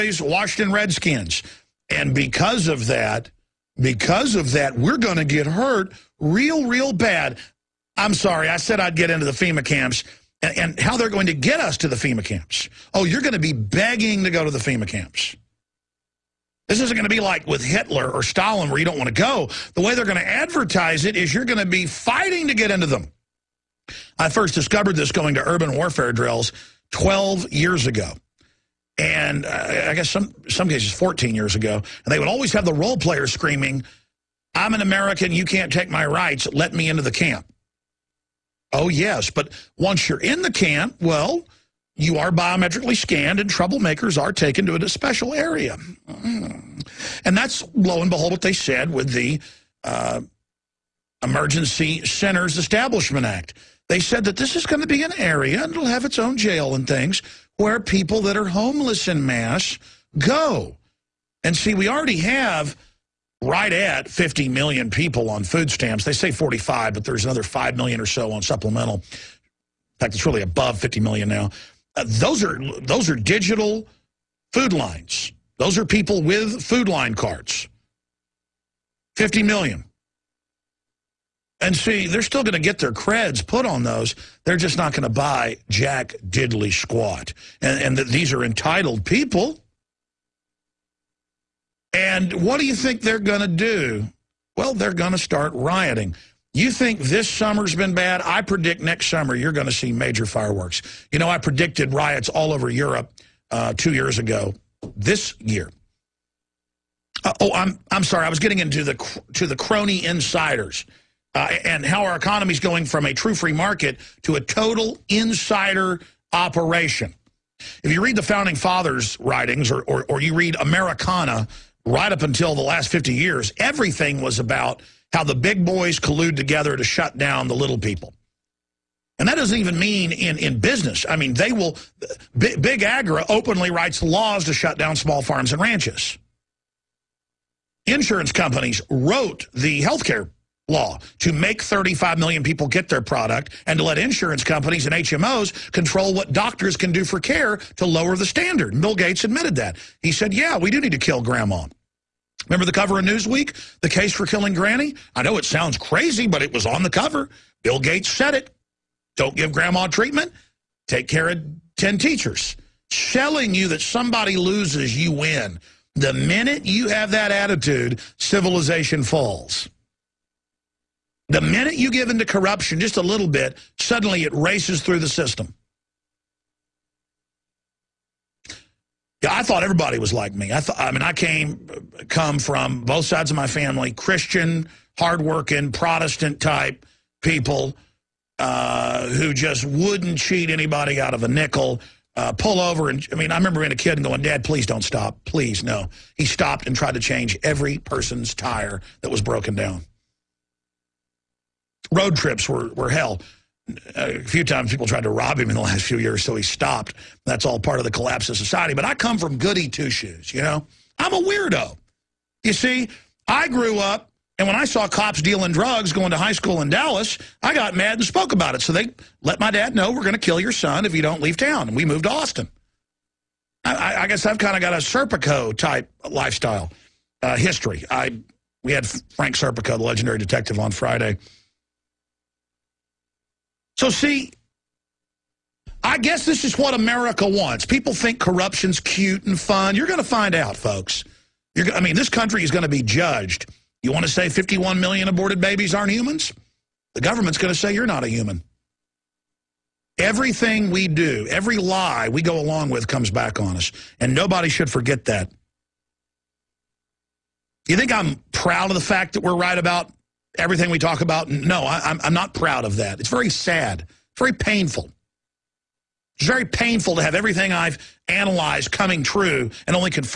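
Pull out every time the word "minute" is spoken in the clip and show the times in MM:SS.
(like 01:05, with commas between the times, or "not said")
02:46, 02:51.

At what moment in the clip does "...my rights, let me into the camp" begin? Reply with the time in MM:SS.
00:35.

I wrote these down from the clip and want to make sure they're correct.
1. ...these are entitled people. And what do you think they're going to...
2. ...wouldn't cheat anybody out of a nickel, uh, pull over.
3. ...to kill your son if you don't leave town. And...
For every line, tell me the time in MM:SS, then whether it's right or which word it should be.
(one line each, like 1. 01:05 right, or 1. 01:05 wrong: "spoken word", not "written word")
1. 01:28 right
2. 03:09 right
3. 03:40 right.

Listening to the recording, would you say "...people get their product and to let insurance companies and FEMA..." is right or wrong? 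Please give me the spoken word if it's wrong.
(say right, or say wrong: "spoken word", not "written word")
wrong: "HMOs", not "FEMA".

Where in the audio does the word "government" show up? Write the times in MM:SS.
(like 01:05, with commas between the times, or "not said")
04:06.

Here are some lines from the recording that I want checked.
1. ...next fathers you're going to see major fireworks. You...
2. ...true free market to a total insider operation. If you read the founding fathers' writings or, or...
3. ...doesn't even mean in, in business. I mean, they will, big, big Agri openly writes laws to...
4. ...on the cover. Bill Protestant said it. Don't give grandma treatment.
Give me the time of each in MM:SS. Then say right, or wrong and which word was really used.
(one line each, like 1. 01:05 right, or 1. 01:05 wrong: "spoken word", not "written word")
1. 01:38 wrong: "summer", not "fathers"
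2. 01:53 right
3. 02:09 right
4. 02:36 wrong: "Gates", not "Protestant".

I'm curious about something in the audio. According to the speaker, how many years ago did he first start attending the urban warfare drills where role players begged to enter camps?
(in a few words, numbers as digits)
12 years.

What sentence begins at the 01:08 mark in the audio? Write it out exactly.
In fact, it's really above 50 million now.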